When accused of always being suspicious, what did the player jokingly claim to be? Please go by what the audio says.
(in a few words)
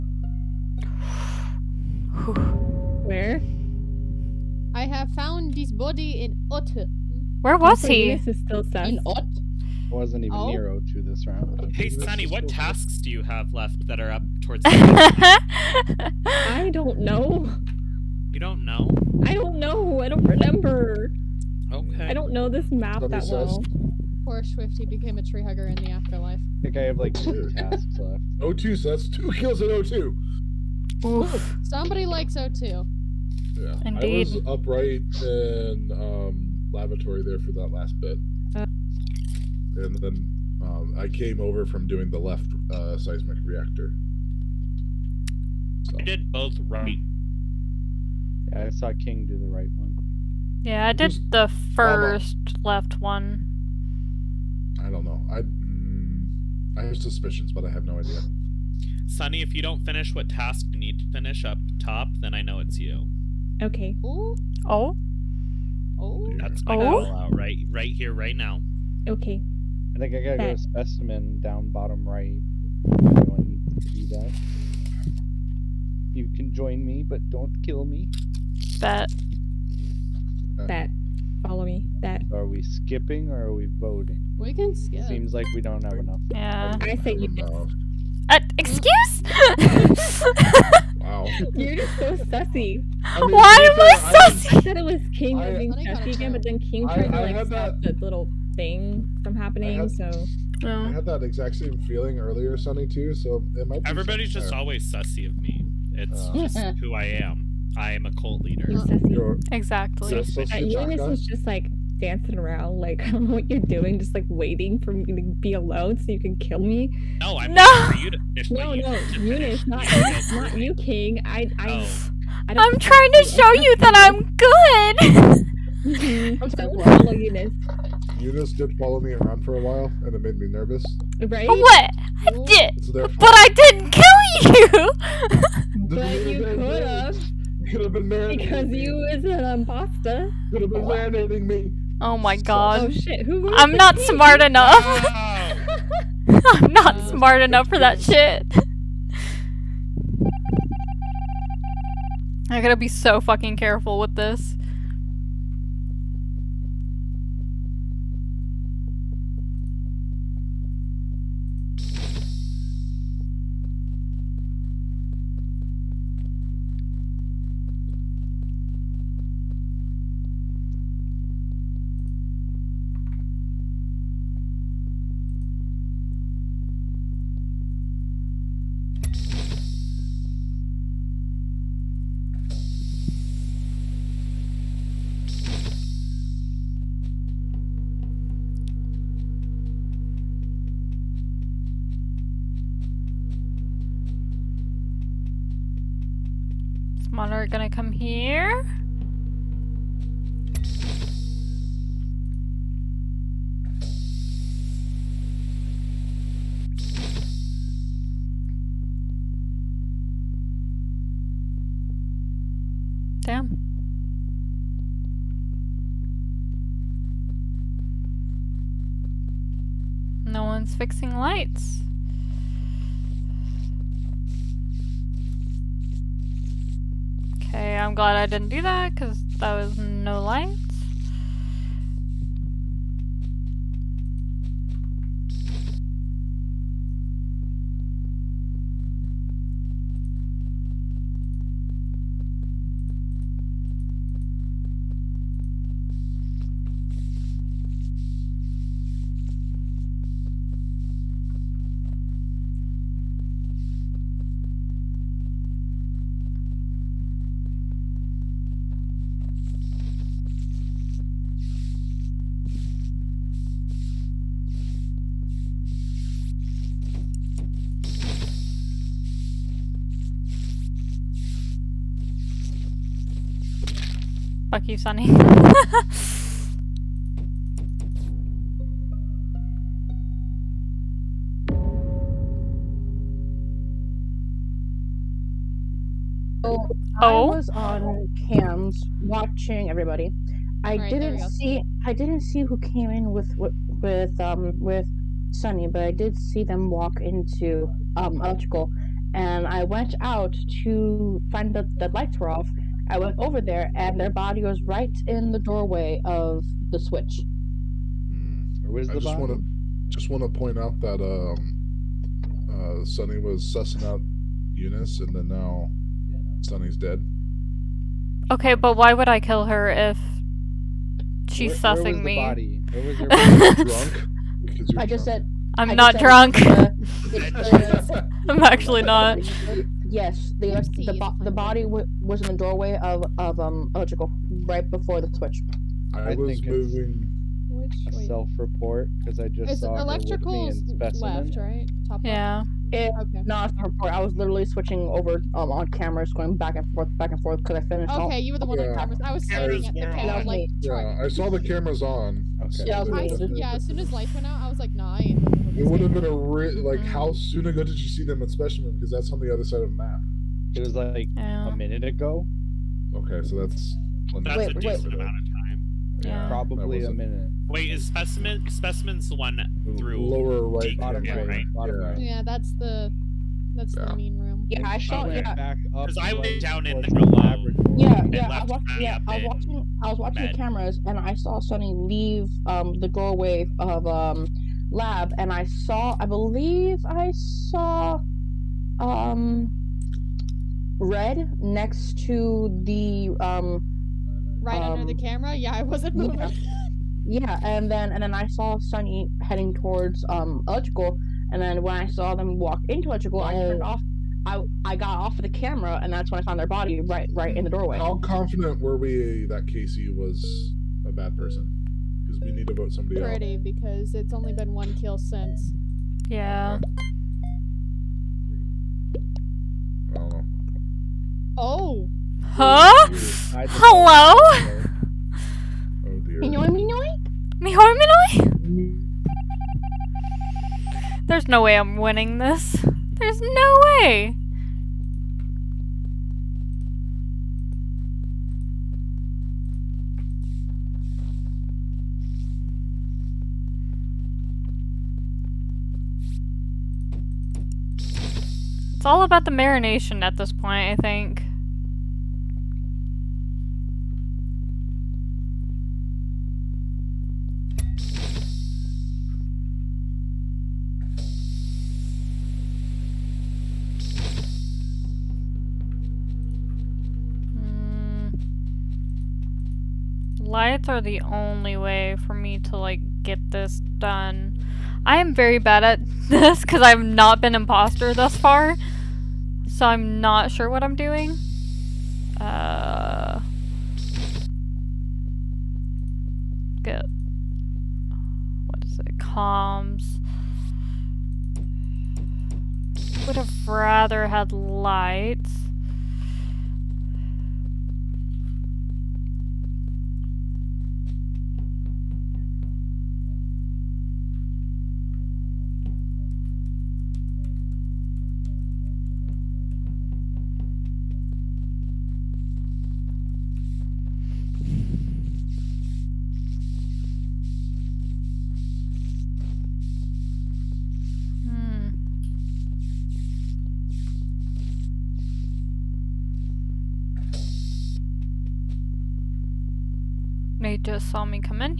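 A cult leader.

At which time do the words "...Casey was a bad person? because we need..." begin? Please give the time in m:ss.
6:49.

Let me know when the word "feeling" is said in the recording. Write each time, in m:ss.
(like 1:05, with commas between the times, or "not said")
1:41.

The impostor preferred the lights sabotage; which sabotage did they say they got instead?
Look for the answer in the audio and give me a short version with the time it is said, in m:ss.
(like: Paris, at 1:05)
Comms, at 8:08.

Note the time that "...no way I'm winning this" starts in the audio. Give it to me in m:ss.
7:11.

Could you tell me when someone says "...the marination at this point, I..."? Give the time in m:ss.
7:29.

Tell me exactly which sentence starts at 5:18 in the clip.
Okay, um, but why would I kill her if she's where, sussing where was me?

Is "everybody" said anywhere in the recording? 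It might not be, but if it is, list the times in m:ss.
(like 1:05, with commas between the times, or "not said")
1:43, 4:49.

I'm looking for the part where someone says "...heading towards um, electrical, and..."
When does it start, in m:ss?
6:39.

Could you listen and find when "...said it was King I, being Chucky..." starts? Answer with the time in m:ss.
1:34.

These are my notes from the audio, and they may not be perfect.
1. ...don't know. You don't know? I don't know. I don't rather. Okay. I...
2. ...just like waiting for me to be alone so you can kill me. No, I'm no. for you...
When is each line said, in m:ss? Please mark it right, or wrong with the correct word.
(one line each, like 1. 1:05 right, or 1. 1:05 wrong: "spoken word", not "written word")
1. 0:16 wrong: "remember", not "rather"
2. 1:53 right.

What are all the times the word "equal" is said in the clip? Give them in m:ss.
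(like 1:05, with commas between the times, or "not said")
not said.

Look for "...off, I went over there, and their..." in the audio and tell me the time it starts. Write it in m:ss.
5:02.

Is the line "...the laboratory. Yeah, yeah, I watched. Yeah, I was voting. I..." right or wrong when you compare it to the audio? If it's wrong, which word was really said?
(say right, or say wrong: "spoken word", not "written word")
wrong: "watching", not "voting".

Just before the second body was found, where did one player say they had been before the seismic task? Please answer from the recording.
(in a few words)
Lavatory.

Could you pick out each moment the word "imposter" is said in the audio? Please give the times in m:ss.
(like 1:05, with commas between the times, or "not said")
2:19, 7:57.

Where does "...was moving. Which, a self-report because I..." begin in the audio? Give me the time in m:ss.
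5:36.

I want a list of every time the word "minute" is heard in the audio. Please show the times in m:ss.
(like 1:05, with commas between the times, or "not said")
6:01, 6:06.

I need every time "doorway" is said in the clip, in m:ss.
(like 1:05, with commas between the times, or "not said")
5:05, 5:32, 6:22, 6:47.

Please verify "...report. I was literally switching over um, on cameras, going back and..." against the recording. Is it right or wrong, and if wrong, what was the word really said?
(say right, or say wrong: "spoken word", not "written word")
right.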